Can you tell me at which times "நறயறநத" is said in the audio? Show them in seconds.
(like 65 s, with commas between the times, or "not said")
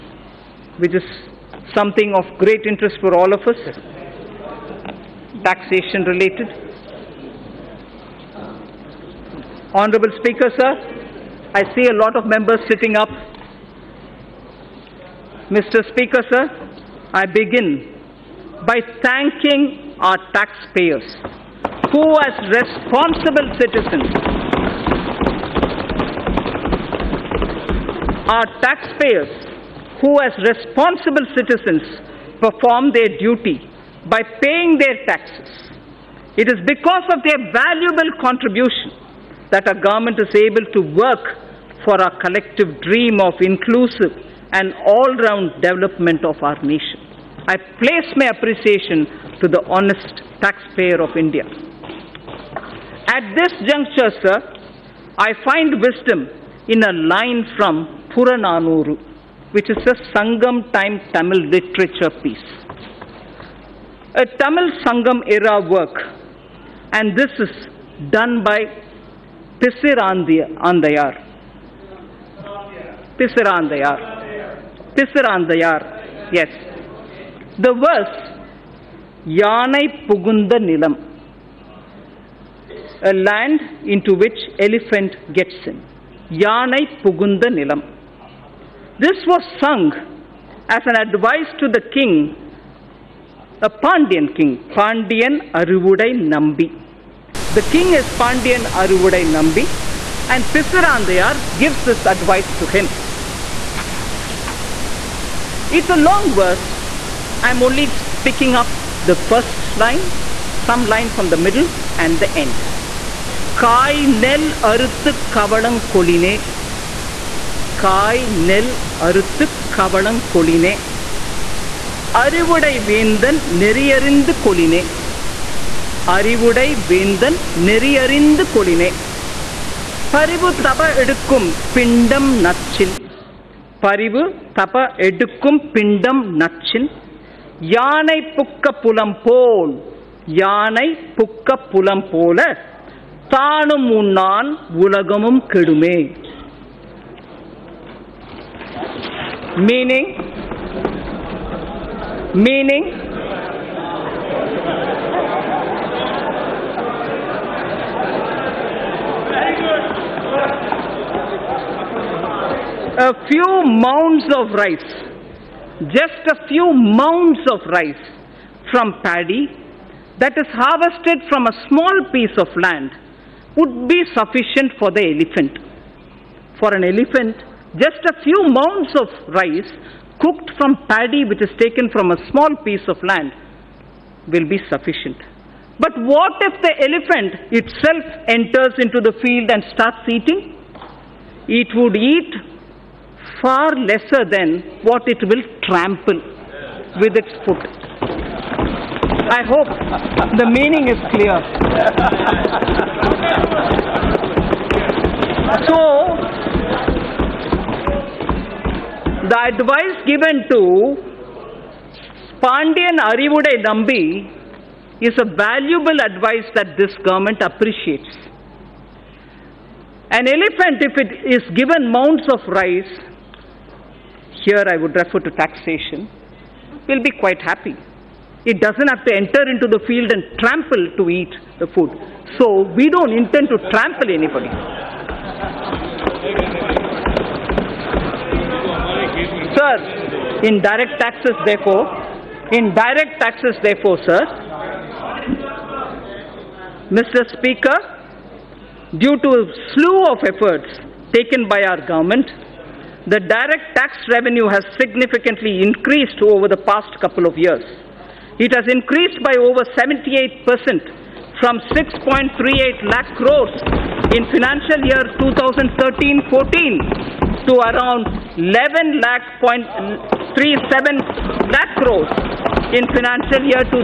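123 s, 127 s.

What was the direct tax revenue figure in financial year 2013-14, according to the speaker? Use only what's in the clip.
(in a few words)
6.38 lakh crores.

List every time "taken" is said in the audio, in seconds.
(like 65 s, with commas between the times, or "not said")
181 s, 251 s.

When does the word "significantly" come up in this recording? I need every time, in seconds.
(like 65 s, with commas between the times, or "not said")
254 s.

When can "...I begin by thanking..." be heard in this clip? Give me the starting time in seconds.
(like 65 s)
17 s.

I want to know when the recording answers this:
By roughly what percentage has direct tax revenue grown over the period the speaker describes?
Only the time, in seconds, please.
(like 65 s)
259 s.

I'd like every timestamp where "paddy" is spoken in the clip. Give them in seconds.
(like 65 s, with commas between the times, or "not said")
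169 s, 180 s.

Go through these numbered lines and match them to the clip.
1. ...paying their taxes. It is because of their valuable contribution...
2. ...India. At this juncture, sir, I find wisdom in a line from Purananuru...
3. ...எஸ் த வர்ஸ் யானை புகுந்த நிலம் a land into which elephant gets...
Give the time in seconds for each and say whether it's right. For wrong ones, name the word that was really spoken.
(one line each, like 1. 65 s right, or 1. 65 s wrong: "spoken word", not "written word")
1. 34 s right
2. 51 s right
3. 76 s right.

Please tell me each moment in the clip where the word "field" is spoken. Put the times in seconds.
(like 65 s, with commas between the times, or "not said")
189 s, 229 s.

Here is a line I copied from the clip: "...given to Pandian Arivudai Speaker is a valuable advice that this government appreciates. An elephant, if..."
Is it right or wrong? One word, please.
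wrong.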